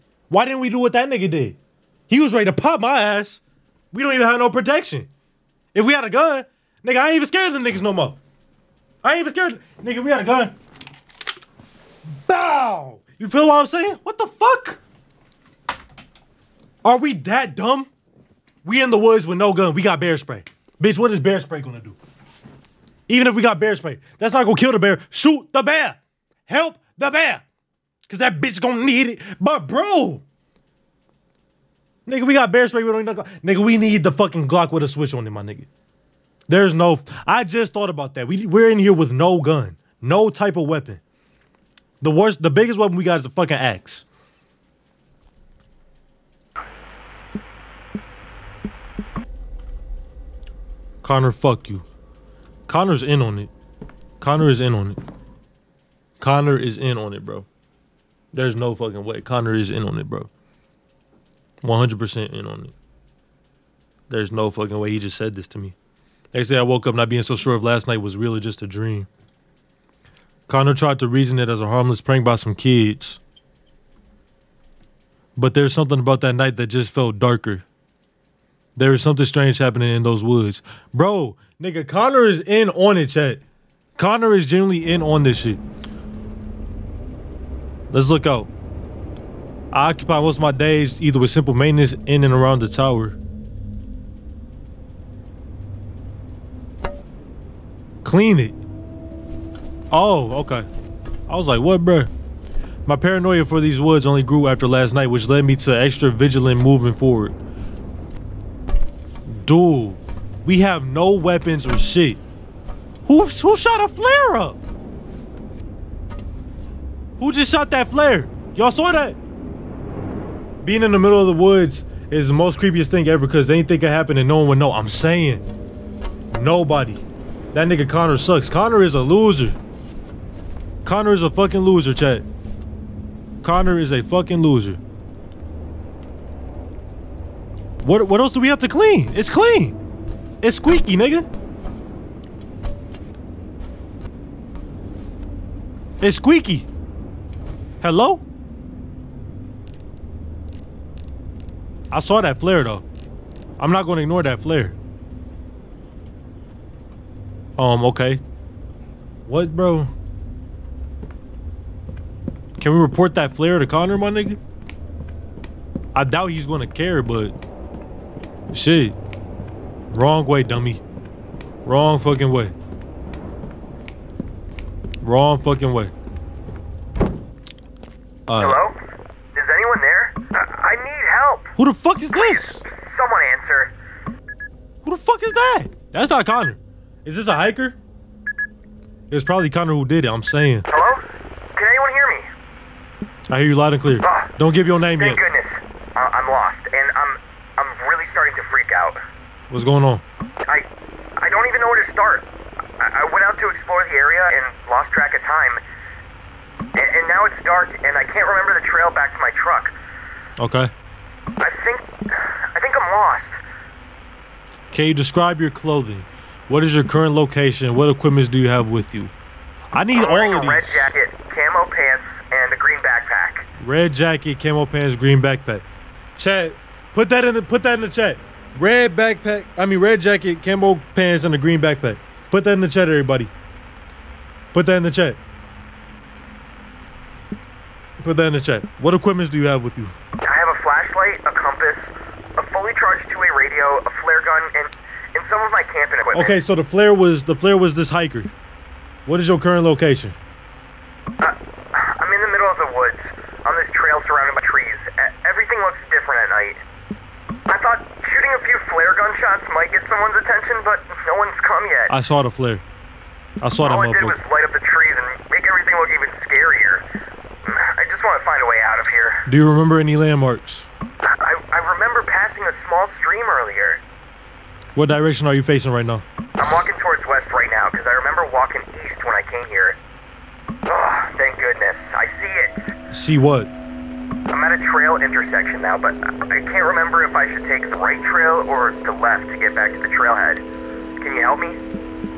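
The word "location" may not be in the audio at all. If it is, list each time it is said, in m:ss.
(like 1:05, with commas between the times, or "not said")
3:37, 4:09.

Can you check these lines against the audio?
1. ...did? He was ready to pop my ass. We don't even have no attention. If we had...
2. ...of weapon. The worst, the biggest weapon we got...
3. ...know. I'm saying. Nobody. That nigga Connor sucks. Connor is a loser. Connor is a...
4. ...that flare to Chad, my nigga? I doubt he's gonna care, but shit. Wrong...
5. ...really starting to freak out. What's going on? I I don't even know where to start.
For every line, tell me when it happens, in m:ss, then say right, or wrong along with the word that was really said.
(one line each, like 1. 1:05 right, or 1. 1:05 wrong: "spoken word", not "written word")
1. 0:01 wrong: "protection", not "attention"
2. 0:40 right
3. 2:04 right
4. 2:43 wrong: "Connor", not "Chad"
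5. 3:17 right.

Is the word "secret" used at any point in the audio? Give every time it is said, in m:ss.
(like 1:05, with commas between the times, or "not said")
not said.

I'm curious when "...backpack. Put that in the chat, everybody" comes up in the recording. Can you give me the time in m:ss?
3:51.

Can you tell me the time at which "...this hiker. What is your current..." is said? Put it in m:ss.
4:07.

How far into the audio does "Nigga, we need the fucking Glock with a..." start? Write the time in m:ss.
0:33.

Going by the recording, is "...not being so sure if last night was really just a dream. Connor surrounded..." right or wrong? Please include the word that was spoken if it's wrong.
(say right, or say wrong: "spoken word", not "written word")
wrong: "tried", not "surrounded".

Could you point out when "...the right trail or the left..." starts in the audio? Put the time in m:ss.
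4:47.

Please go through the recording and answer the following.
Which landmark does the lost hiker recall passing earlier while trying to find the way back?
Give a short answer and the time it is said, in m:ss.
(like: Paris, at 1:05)
A small stream, at 4:32.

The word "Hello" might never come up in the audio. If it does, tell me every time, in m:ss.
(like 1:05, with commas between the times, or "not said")
2:27, 2:58, 3:10.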